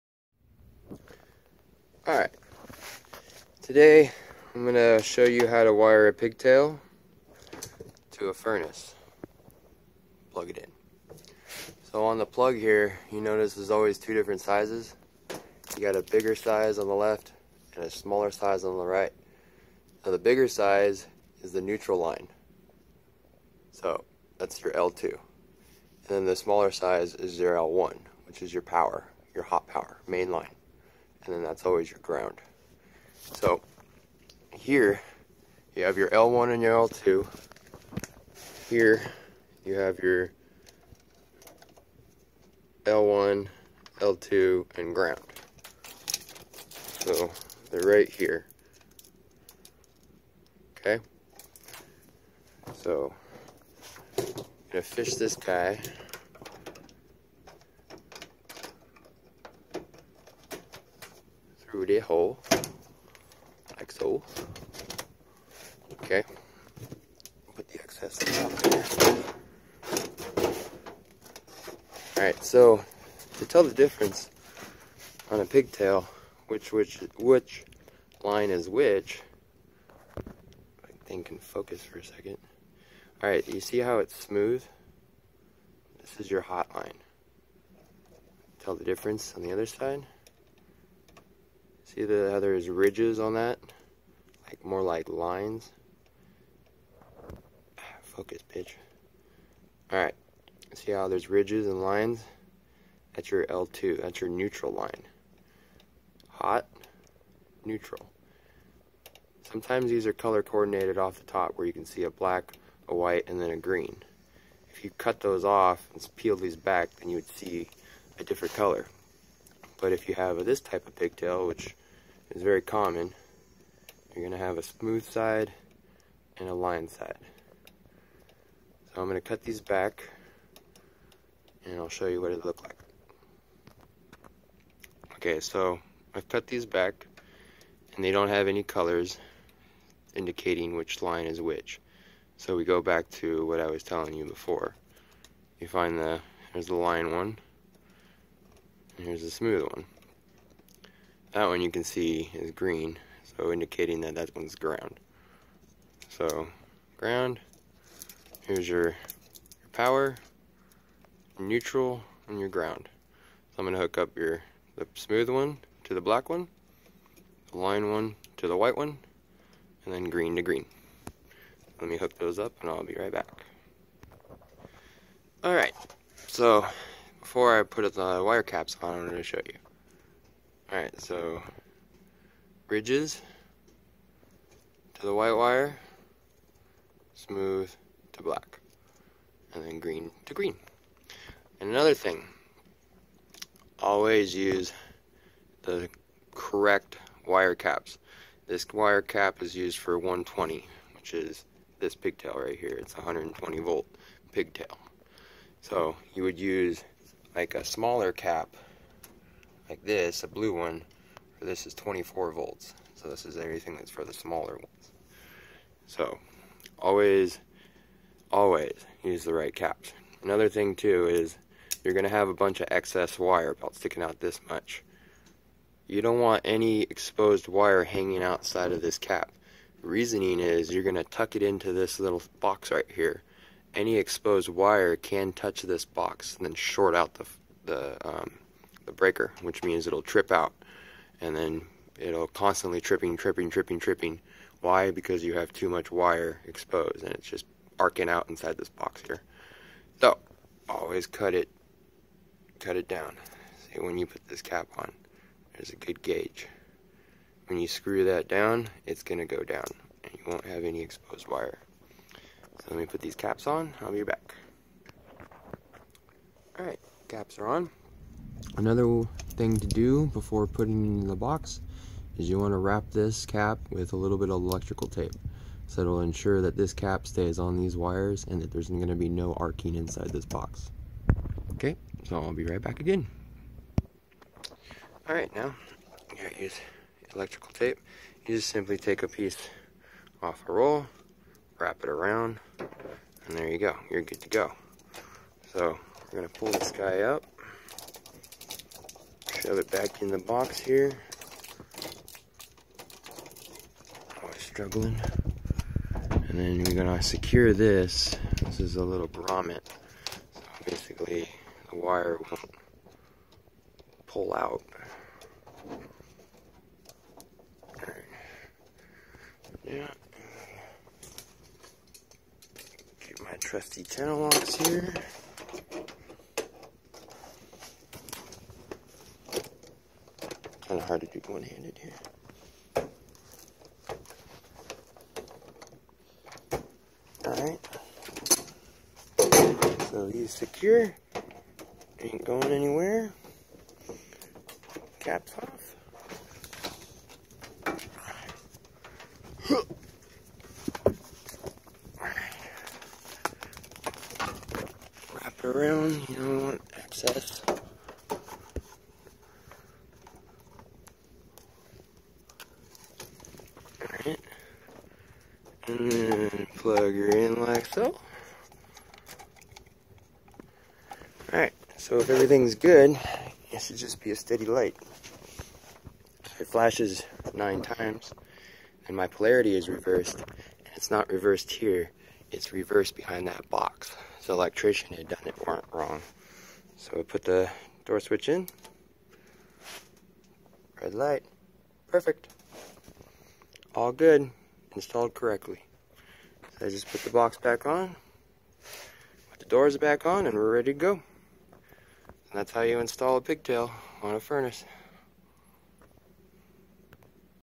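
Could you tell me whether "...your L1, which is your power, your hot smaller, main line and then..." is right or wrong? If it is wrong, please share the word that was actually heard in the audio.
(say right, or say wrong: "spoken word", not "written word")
wrong: "power", not "smaller".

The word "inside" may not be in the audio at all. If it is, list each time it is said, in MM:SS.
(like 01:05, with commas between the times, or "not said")
04:08, 04:39.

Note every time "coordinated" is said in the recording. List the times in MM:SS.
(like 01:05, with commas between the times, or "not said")
01:50.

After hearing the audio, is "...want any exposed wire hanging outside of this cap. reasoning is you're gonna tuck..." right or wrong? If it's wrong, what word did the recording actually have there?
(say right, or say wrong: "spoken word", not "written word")
right.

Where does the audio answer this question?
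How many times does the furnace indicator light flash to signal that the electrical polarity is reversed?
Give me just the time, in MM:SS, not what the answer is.
06:17.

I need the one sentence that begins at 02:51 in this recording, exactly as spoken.
Let me hook those up and I'll be right back.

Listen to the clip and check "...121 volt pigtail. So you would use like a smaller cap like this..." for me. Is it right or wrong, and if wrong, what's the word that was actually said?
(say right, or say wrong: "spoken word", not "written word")
wrong: "120", not "121".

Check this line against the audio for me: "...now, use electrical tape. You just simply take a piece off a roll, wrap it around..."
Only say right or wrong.
right.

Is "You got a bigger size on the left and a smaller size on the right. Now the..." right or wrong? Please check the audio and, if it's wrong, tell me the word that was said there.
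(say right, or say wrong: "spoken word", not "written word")
right.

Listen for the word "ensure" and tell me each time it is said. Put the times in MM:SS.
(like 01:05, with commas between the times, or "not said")
04:36.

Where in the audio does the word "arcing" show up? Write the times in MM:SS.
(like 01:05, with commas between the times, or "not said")
04:07, 04:39.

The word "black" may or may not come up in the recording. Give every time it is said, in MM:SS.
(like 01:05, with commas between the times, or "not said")
01:52, 02:46, 03:08.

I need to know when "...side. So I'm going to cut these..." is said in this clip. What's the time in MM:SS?
02:06.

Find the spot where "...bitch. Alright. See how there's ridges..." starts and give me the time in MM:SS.
01:38.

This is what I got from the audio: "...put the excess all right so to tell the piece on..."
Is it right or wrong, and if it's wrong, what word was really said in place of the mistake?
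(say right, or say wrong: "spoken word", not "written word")
wrong: "difference", not "piece".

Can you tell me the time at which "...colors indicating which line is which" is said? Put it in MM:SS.
02:18.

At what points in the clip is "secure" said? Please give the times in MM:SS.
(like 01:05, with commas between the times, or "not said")
05:07, 05:40.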